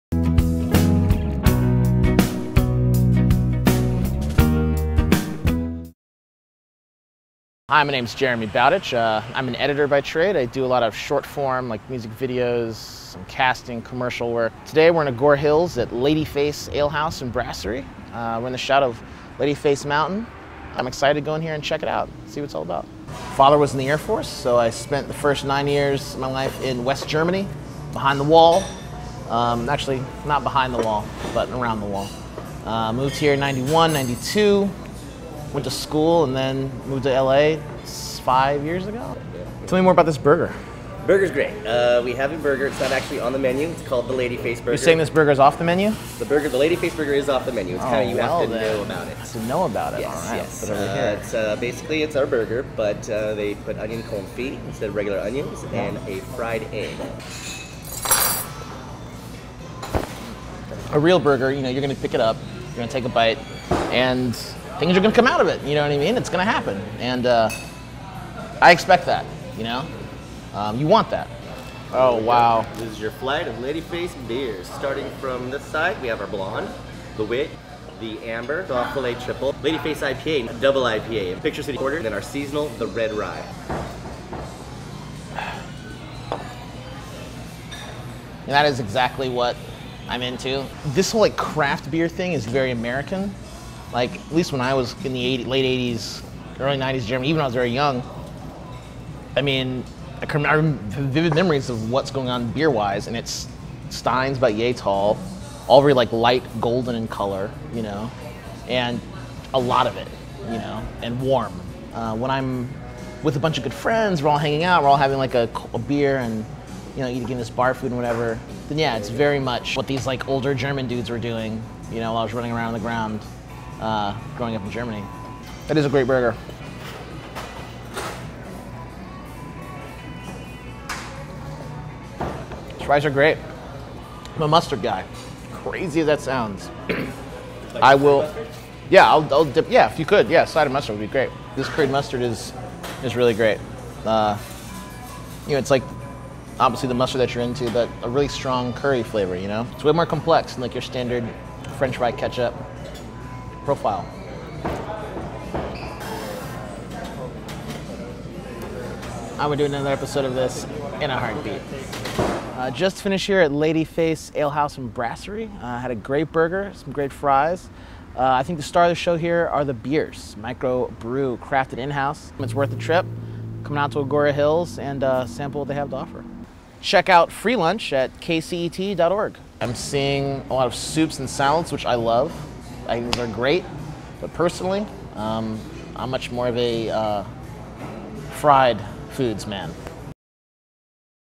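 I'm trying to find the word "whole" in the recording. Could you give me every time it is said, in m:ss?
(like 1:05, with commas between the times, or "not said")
1:31.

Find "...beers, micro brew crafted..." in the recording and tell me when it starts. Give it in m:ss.
2:49.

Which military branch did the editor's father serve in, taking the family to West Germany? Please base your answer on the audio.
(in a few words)
Air Force.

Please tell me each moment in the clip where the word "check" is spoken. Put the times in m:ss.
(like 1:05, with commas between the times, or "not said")
0:21, 2:56.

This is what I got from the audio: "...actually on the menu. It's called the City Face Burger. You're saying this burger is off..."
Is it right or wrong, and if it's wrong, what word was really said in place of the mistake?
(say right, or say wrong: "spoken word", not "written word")
wrong: "Lady", not "City".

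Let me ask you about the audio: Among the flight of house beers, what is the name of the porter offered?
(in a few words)
Picture City Porter.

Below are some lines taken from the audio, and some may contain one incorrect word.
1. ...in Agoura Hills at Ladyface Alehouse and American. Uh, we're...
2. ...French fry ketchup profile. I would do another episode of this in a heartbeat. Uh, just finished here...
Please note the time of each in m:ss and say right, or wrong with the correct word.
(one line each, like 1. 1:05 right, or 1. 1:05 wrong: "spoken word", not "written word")
1. 0:15 wrong: "Brasserie", not "American"
2. 2:31 right.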